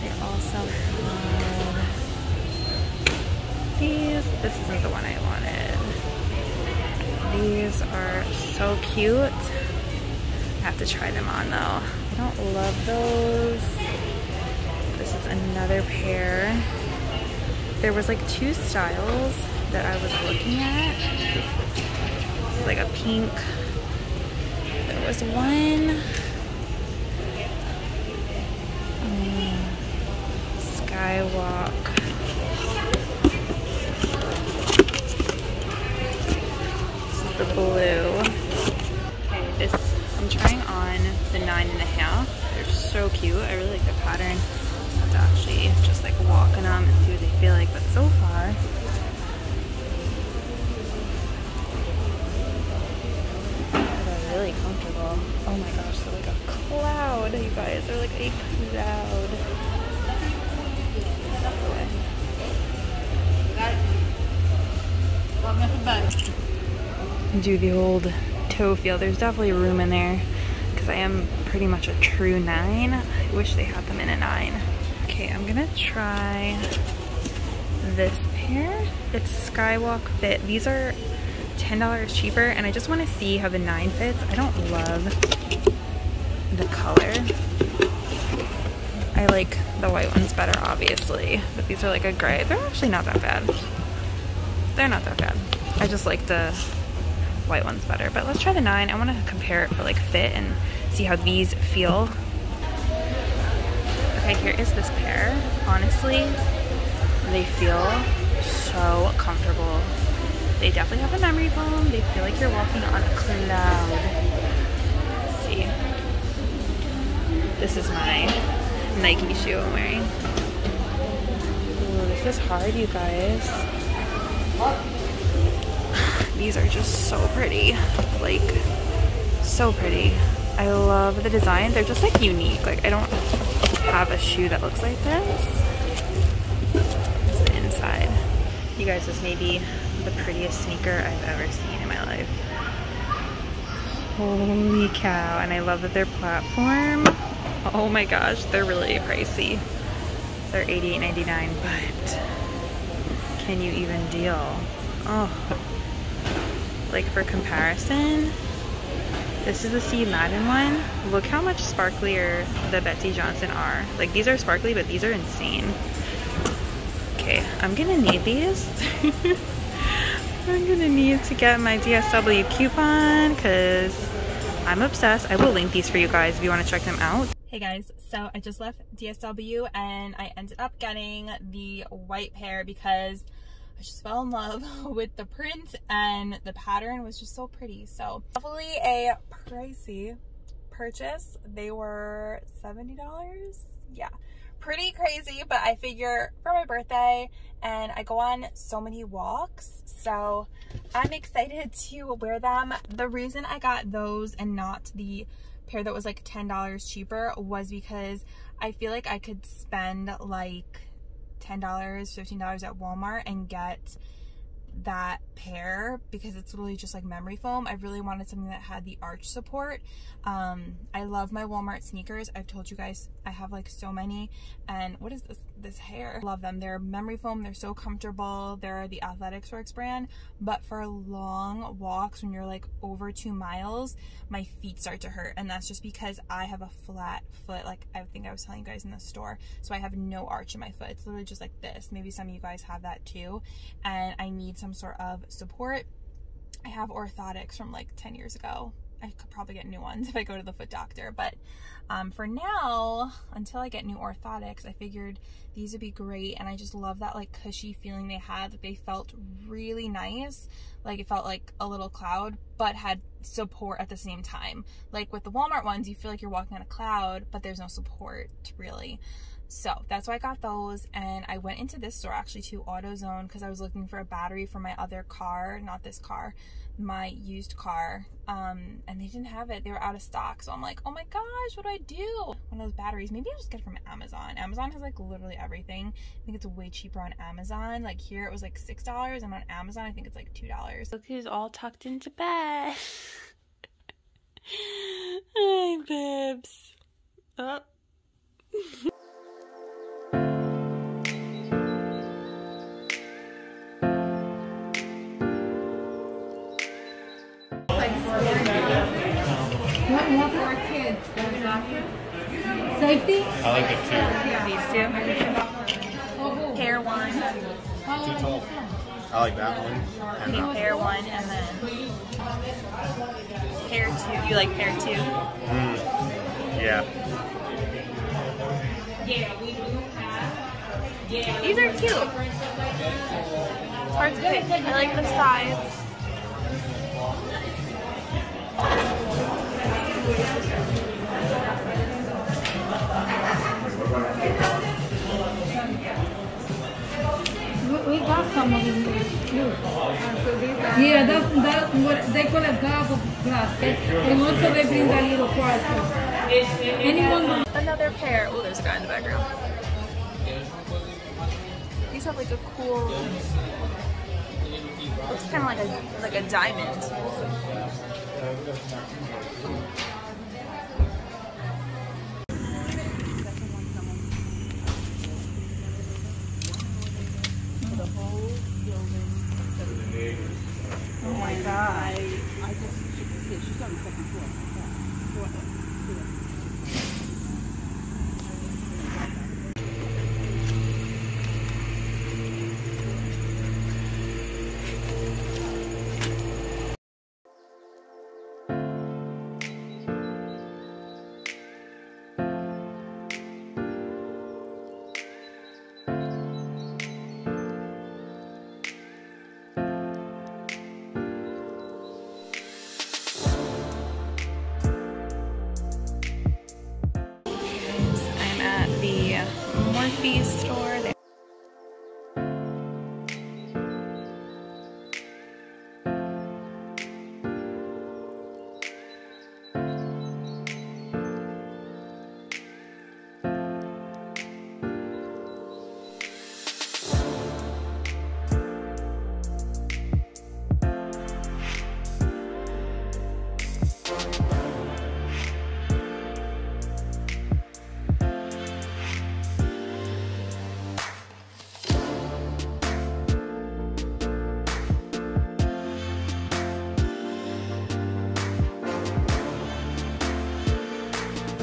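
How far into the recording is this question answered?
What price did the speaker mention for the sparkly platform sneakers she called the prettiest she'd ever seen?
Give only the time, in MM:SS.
02:30.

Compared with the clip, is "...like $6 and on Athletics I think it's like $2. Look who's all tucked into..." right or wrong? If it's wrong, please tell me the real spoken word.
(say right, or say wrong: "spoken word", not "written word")
wrong: "Amazon", not "Athletics".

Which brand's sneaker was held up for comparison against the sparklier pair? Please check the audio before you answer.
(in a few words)
Steve Madden.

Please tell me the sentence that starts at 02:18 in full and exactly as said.
You guys, this may be the prettiest sneaker I've ever seen in my life.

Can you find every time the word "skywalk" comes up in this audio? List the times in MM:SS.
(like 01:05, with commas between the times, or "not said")
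00:30, 01:19.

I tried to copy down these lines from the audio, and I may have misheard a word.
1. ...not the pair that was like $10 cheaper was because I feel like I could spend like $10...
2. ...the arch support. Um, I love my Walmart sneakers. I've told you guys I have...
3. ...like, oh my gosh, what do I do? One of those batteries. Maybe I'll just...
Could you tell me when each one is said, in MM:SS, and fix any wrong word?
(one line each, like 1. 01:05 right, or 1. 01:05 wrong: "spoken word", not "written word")
1. 03:24 right
2. 03:38 right
3. 04:40 right.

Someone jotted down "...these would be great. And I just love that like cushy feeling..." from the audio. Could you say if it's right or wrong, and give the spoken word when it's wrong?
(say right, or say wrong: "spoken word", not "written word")
right.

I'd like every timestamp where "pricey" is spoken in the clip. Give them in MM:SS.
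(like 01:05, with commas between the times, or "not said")
02:28, 03:09.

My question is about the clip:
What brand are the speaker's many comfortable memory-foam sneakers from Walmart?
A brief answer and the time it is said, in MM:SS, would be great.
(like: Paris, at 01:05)
Athletics Works, at 03:49.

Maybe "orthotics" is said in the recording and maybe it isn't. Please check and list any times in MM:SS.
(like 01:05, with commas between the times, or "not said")
04:06, 04:13.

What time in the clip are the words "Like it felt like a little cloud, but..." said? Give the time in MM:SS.
04:20.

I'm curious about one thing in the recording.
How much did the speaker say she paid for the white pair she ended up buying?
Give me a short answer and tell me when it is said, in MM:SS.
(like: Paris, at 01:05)
$70, at 03:12.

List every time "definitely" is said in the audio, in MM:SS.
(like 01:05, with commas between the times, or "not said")
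01:09, 01:50, 03:08.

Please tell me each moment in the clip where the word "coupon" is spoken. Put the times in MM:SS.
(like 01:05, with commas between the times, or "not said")
02:52.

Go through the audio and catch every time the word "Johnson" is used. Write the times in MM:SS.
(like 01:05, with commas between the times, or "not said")
02:43.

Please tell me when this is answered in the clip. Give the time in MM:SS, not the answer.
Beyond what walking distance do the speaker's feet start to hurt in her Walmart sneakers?
03:53.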